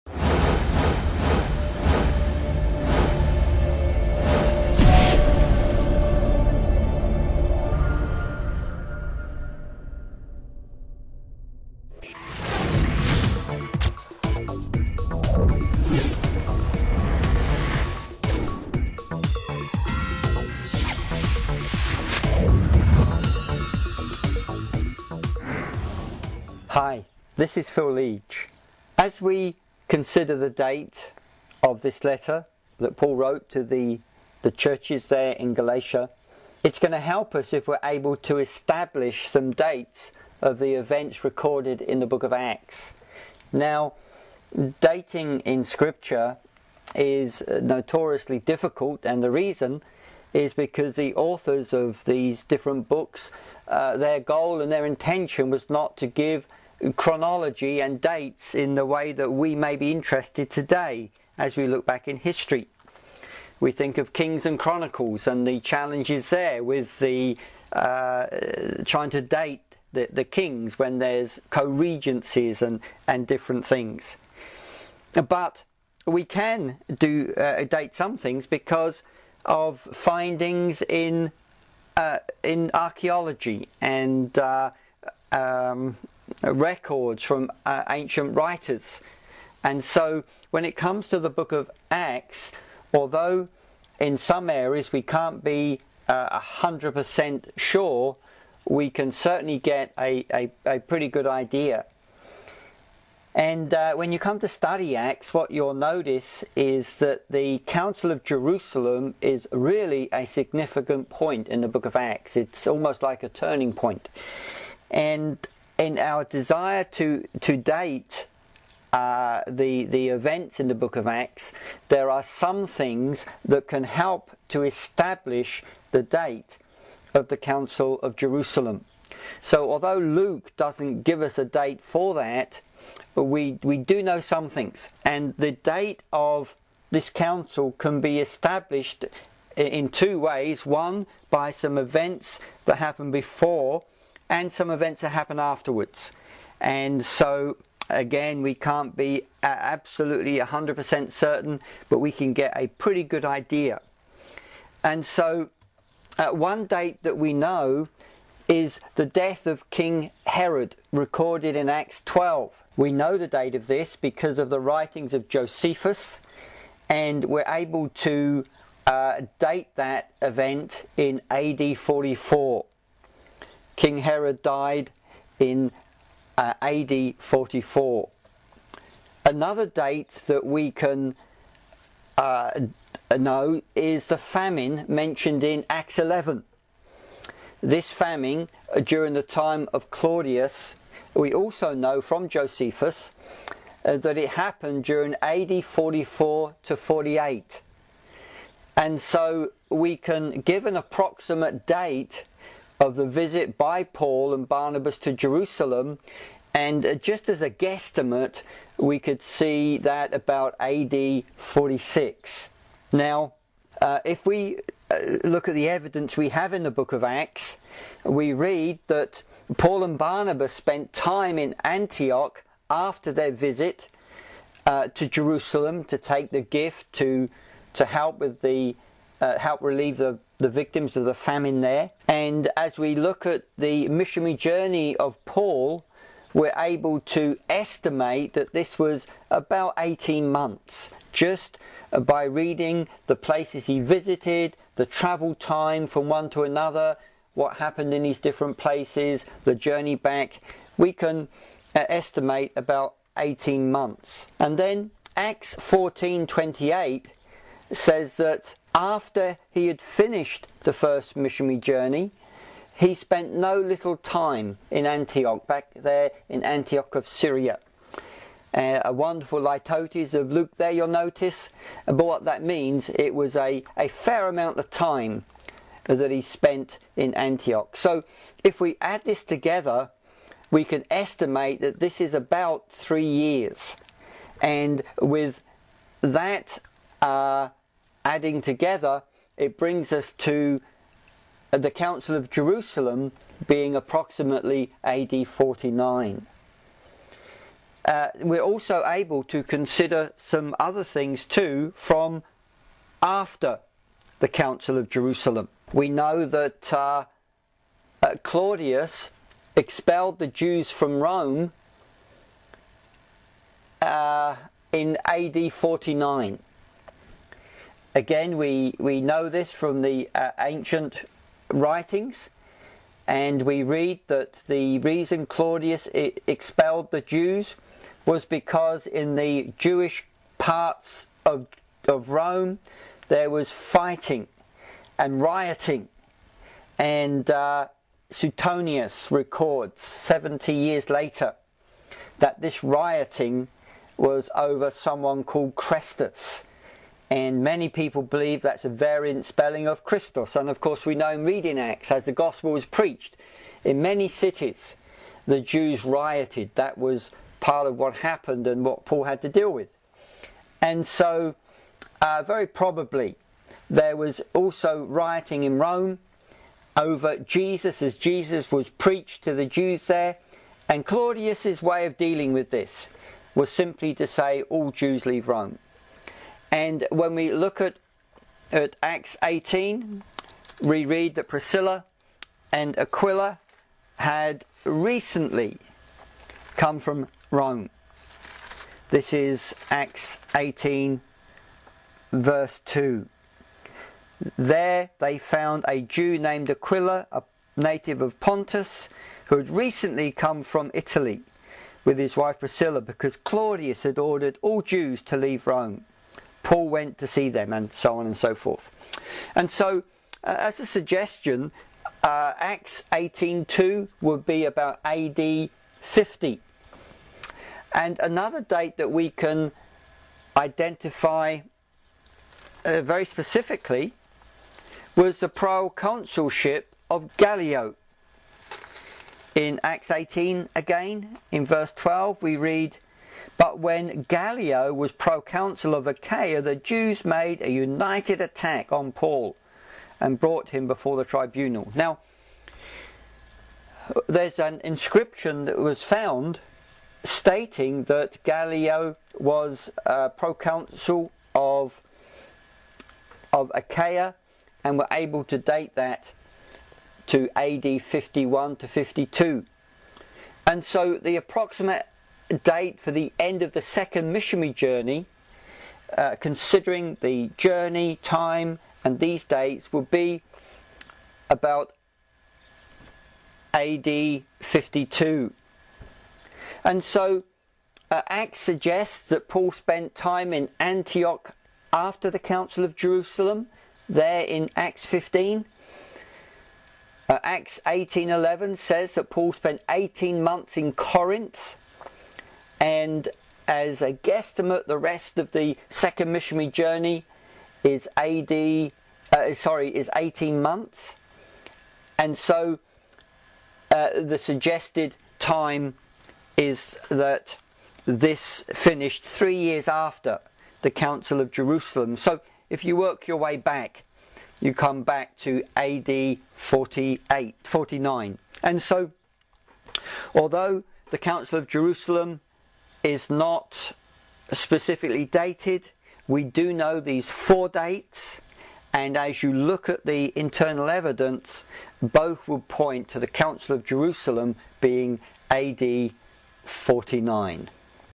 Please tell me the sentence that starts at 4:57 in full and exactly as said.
Uh, we're also able to consider some other things too from after the Council of Jerusalem.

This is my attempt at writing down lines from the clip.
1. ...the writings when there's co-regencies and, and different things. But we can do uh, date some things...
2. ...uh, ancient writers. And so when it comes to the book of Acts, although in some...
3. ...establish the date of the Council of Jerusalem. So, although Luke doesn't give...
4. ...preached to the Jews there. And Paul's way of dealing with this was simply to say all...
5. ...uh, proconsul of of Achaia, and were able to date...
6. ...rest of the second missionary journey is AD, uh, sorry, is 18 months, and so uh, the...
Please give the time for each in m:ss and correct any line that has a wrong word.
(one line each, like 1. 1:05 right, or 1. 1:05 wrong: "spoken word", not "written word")
1. 1:10 wrong: "kings", not "writings"
2. 1:27 right
3. 2:04 right
4. 6:08 wrong: "Claudius", not "Paul"
5. 7:29 right
6. 8:14 right.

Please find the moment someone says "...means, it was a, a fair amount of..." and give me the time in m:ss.
4:32.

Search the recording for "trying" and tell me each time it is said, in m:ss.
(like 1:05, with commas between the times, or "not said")
1:08.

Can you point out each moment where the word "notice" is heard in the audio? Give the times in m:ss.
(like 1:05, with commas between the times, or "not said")
1:45, 4:30.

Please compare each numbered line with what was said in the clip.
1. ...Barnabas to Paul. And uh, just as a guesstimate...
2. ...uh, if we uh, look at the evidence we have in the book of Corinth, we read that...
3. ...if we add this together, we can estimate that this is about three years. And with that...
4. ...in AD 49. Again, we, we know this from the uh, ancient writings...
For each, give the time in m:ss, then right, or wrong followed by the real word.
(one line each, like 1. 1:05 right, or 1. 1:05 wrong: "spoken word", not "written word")
1. 3:24 wrong: "Jerusalem", not "Paul"
2. 3:33 wrong: "Acts", not "Corinth"
3. 4:38 right
4. 5:14 right.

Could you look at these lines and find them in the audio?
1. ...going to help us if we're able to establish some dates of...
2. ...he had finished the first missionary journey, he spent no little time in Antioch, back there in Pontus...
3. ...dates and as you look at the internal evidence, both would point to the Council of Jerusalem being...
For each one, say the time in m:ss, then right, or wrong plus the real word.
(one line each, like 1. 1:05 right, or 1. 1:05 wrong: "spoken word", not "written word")
1. 0:36 right
2. 4:19 wrong: "Antioch", not "Pontus"
3. 8:47 right.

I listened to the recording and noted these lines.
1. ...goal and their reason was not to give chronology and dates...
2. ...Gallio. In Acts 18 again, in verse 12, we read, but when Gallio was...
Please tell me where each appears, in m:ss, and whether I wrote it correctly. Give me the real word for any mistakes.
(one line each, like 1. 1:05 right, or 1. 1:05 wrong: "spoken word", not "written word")
1. 0:54 wrong: "intention", not "reason"
2. 7:07 right.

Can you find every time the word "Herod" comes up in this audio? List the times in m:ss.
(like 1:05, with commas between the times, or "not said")
2:40, 2:54.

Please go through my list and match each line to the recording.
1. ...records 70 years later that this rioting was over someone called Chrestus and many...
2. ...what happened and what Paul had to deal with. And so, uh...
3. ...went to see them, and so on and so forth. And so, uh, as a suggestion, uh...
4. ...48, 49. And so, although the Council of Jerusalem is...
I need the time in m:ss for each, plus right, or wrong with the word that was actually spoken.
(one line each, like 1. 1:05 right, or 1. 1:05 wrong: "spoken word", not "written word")
1. 5:39 right
2. 5:57 right
3. 6:46 right
4. 8:36 right.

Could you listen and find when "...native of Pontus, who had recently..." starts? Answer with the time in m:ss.
6:37.